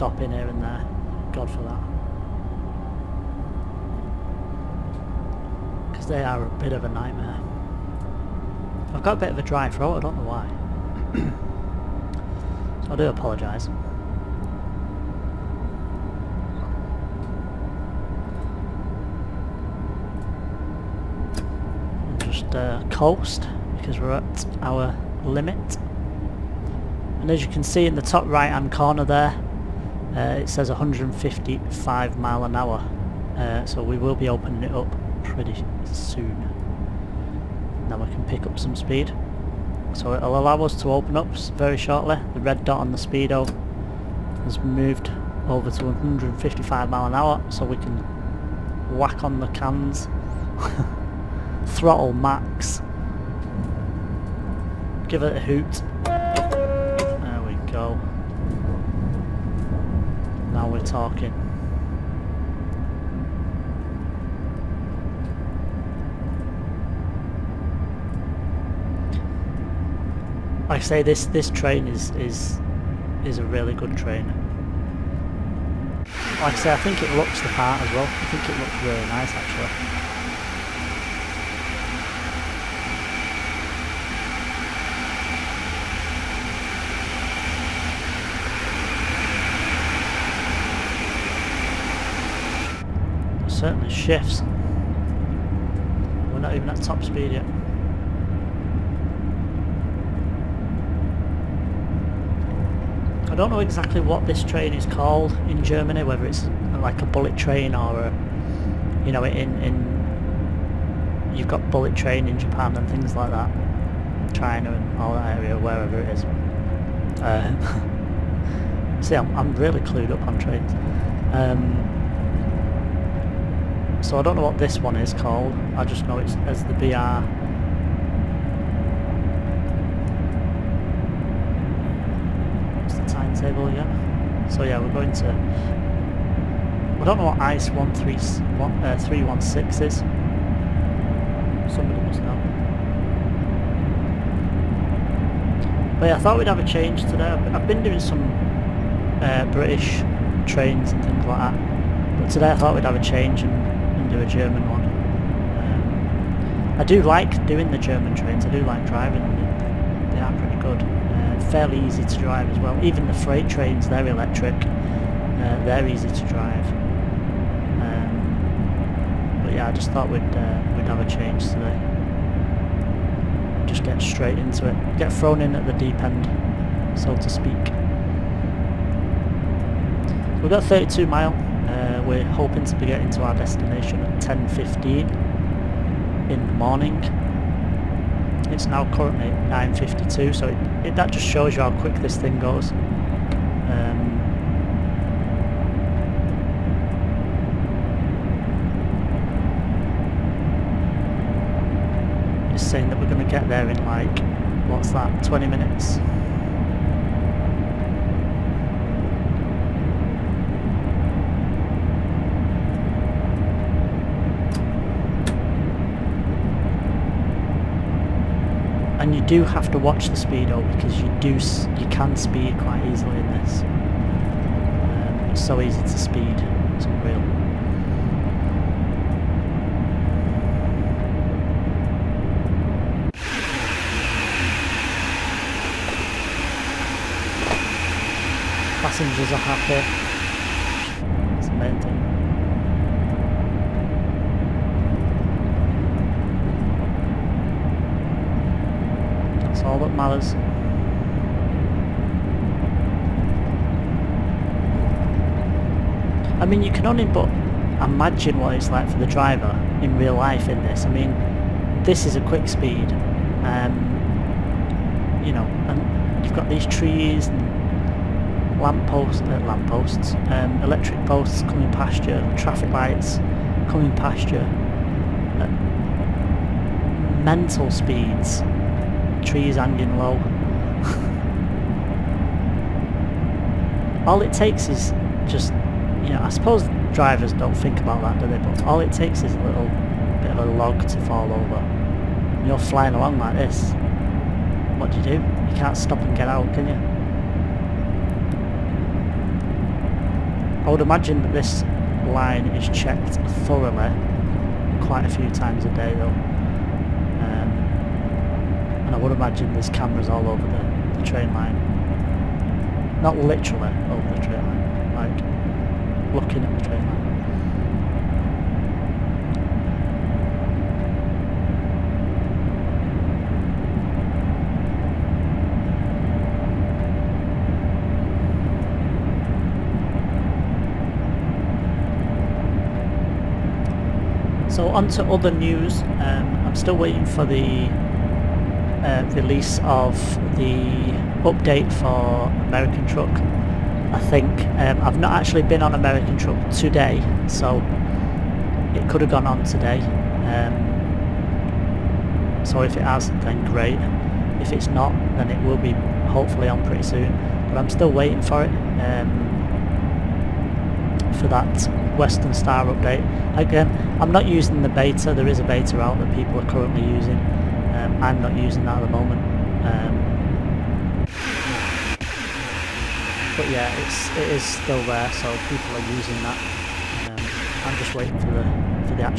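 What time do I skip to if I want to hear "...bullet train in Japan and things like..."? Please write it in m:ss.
1:51.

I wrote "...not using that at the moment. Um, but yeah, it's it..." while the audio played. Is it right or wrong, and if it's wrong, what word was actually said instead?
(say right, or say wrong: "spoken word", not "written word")
right.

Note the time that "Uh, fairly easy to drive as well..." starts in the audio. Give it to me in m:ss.
2:40.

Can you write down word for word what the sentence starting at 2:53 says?
Just get straight into it, get thrown in at the deep end, so to speak.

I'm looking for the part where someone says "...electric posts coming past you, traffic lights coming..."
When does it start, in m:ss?
4:30.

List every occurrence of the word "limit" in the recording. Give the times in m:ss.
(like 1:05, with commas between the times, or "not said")
0:25.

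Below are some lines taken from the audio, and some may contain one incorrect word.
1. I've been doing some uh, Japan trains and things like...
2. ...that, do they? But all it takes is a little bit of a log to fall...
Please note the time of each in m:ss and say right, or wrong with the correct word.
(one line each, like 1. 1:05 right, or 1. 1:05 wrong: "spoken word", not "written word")
1. 2:27 wrong: "British", not "Japan"
2. 4:48 right.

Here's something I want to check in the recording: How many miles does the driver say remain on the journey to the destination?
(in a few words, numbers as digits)
32.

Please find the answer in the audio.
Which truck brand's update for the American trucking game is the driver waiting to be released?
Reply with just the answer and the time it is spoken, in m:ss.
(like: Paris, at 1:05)
Western Star, at 6:01.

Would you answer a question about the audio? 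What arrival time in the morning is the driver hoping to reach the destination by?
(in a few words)
10.15.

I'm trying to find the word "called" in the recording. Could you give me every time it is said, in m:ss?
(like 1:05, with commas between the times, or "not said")
1:44, 2:05.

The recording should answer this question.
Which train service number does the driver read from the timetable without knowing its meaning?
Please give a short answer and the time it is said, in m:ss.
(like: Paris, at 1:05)
ICE 316, at 2:17.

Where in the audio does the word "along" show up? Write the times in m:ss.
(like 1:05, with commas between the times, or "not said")
4:52.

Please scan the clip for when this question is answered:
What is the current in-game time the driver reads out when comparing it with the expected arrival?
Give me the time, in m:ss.
3:09.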